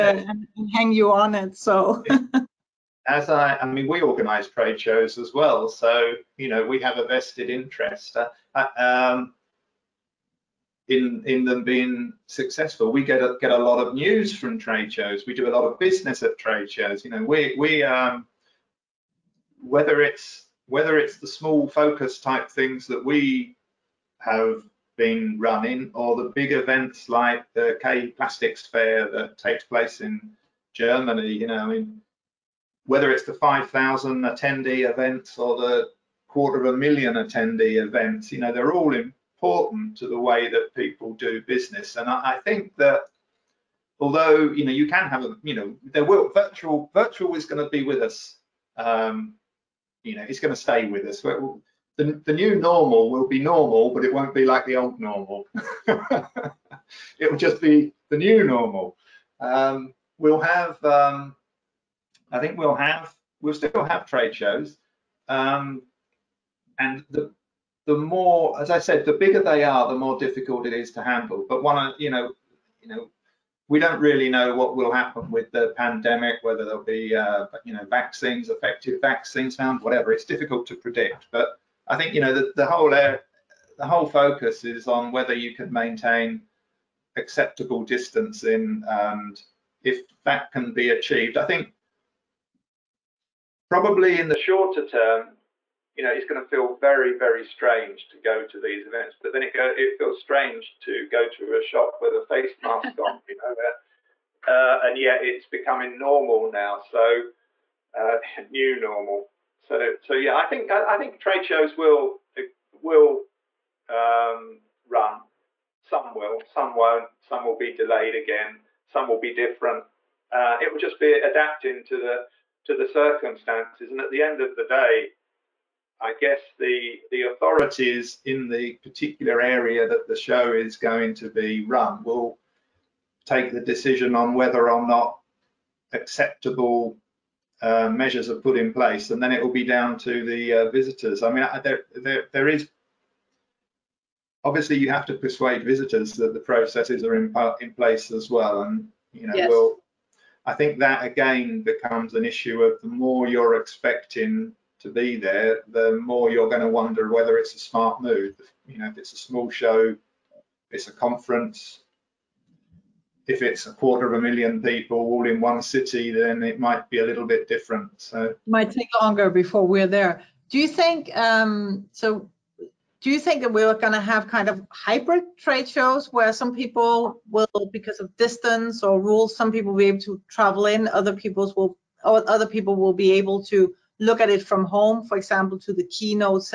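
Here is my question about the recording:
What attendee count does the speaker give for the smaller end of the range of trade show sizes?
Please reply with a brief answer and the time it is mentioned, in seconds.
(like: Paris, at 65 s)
5,000, at 33 s.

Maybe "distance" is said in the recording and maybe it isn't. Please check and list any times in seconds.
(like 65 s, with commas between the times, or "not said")
87 s, 178 s.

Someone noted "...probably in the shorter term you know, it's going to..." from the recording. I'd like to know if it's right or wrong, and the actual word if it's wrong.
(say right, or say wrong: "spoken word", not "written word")
right.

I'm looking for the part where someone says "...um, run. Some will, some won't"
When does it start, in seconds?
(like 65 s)
113 s.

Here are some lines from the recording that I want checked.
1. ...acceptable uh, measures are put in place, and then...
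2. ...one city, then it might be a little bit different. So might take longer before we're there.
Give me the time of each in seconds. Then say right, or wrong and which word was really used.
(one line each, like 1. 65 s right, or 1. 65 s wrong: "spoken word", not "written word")
1. 135 s right
2. 165 s right.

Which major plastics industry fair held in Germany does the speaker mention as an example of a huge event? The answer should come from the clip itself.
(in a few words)
K Plastics Fair.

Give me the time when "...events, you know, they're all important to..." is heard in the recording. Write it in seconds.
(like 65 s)
37 s.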